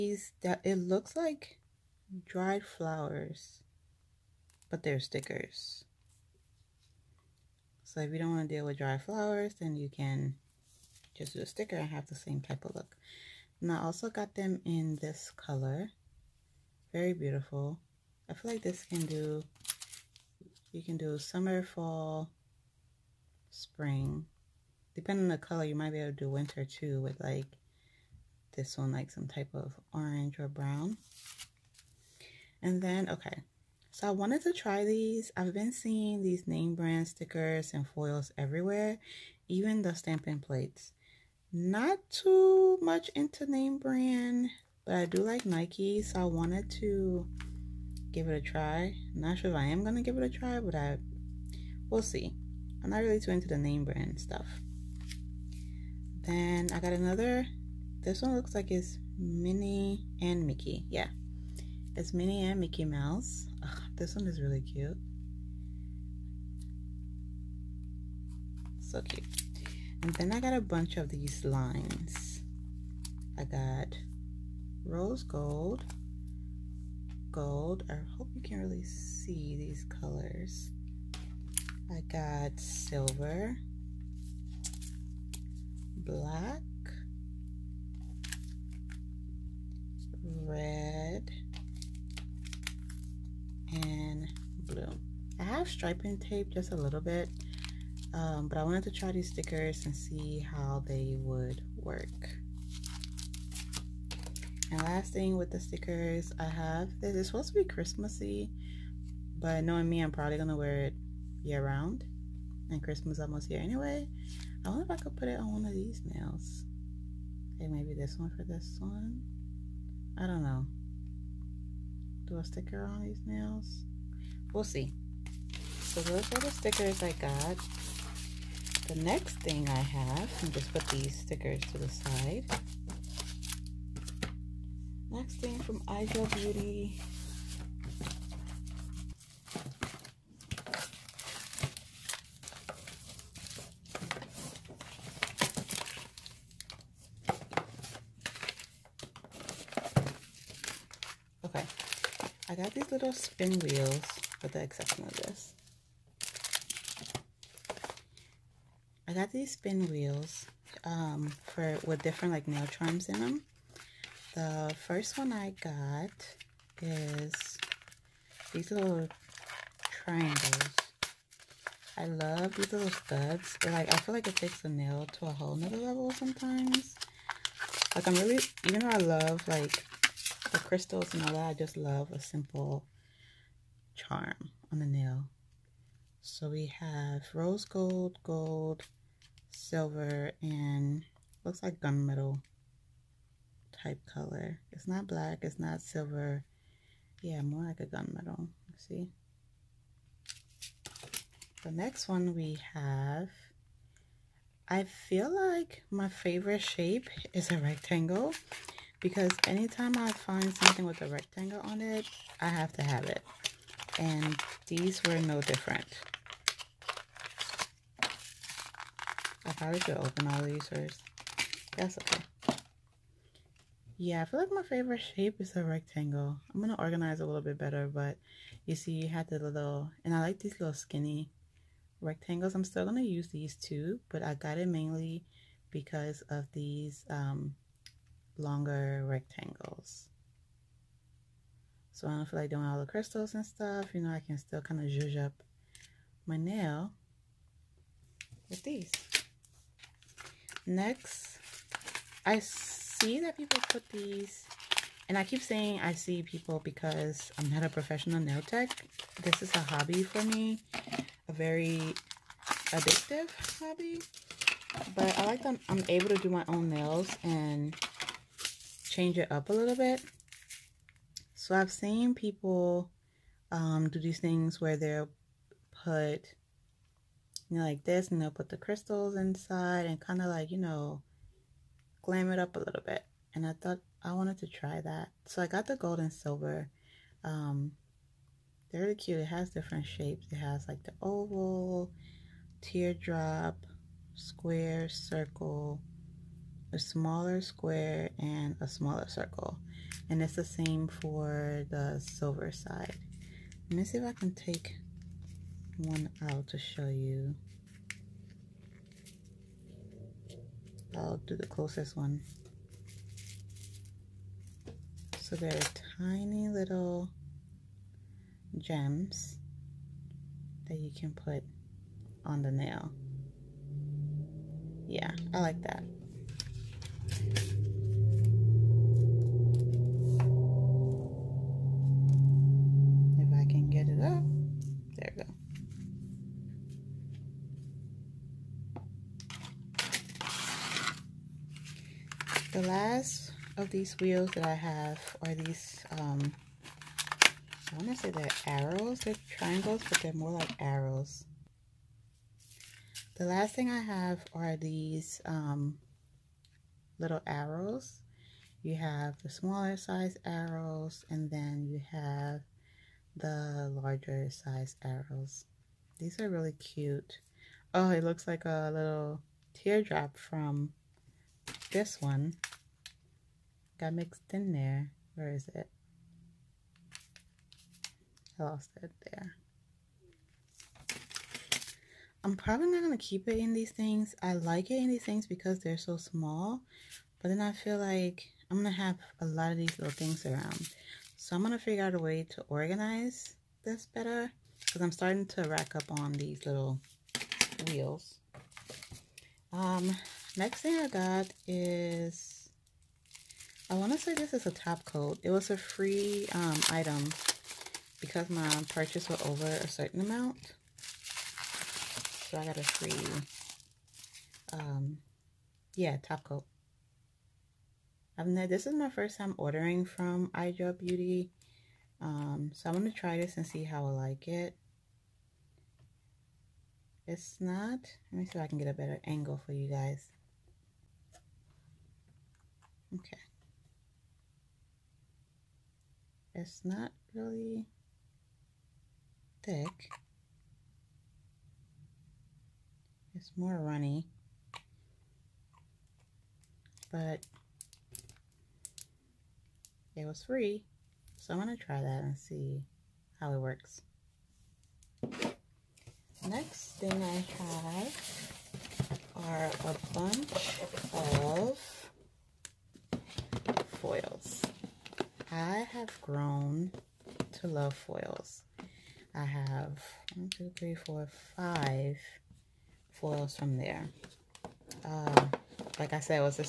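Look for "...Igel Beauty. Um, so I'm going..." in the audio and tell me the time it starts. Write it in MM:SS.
07:00.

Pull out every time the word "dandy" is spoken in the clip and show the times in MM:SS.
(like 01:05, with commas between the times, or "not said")
not said.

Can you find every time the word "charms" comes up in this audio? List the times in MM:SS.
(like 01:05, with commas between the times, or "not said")
02:42, 03:03.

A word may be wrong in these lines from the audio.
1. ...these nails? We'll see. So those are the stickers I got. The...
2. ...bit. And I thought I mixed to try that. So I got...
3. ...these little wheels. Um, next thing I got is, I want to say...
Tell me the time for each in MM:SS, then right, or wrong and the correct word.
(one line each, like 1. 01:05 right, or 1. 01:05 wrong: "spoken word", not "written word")
1. 02:03 right
2. 04:42 wrong: "wanted", not "mixed"
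3. 06:36 right.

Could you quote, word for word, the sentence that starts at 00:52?
I'm not really too into the name brand stuff.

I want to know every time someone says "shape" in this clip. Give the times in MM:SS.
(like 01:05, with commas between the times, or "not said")
03:26, 03:45, 04:49.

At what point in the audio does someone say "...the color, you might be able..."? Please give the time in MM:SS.
00:25.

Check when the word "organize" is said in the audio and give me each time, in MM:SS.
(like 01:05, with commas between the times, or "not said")
03:46, 06:32.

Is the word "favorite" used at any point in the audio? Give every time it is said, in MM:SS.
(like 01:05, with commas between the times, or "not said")
03:26, 03:44.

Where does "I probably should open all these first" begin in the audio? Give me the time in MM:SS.
03:38.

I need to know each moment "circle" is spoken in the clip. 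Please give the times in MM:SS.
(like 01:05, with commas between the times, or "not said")
04:54, 04:59.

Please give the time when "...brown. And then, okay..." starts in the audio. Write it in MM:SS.
00:30.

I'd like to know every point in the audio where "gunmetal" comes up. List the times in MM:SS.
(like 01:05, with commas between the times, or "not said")
03:11, 03:17.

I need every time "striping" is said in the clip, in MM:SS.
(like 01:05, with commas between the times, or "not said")
01:35.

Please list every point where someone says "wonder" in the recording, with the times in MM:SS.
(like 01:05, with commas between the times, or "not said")
01:54.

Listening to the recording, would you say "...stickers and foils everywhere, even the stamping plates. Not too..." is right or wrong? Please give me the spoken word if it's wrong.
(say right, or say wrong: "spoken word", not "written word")
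right.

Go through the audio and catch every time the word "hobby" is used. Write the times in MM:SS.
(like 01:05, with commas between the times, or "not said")
04:19, 04:23.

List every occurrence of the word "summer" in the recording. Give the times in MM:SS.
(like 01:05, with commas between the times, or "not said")
00:21.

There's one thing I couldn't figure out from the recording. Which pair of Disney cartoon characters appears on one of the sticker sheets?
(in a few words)
Minnie and Mickey Mouse.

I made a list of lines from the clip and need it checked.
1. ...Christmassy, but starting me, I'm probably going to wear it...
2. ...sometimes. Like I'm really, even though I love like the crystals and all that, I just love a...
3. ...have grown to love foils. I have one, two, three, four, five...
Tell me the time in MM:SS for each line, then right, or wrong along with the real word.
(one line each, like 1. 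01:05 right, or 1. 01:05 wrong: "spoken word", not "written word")
1. 01:47 wrong: "knowing", not "starting"
2. 02:56 right
3. 07:45 right.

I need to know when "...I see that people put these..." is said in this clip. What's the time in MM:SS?
04:12.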